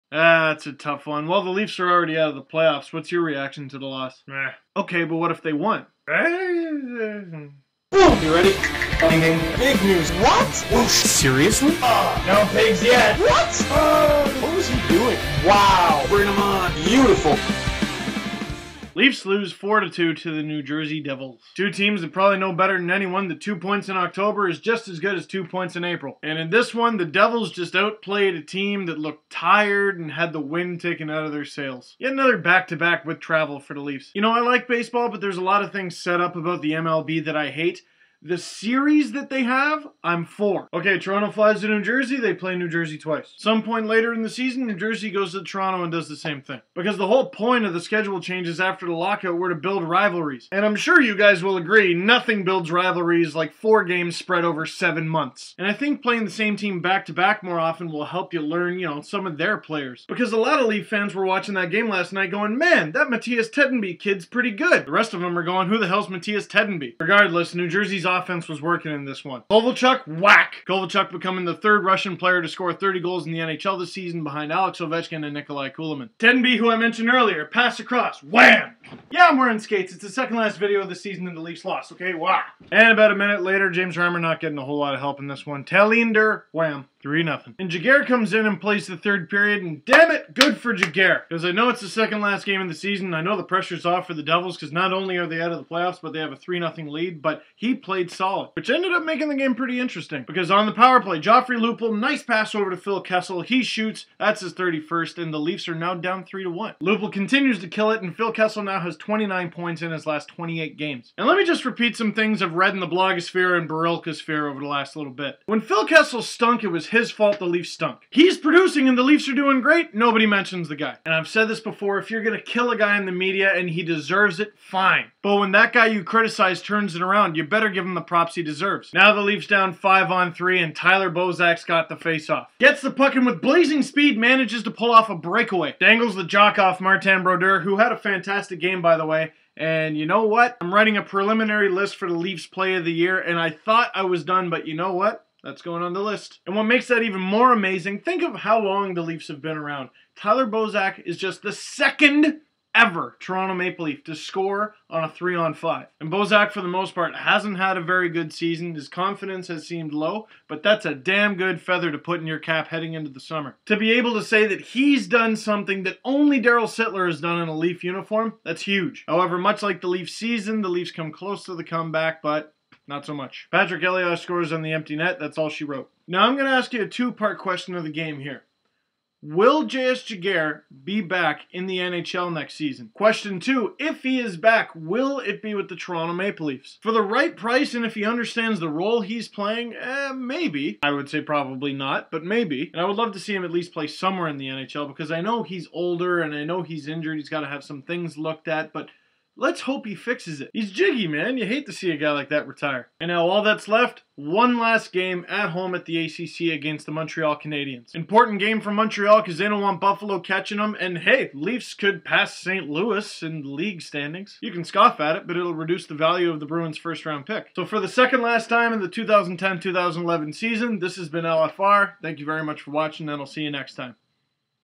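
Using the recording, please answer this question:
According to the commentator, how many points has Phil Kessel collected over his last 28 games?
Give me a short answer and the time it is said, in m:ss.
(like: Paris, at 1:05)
29, at 1:48.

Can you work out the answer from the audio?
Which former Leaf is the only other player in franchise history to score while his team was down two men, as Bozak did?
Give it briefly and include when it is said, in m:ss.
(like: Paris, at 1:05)
Darryl Sittler, at 2:46.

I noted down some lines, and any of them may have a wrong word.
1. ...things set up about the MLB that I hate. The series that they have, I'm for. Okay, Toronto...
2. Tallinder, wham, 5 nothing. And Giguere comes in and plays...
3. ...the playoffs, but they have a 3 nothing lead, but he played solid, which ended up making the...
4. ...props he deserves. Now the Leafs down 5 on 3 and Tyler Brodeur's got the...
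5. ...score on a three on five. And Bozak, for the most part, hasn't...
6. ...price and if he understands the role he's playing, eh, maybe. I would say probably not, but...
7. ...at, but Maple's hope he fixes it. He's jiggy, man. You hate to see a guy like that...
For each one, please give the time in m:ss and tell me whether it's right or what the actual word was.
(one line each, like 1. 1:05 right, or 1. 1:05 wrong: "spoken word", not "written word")
1. 0:35 right
2. 1:25 wrong: "3", not "5"
3. 1:35 right
4. 2:08 wrong: "Bozak", not "Brodeur"
5. 2:34 right
6. 3:07 right
7. 3:18 wrong: "Let", not "Maple".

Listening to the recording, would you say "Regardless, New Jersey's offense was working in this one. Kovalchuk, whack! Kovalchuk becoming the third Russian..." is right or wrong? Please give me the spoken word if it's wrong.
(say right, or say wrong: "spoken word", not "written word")
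right.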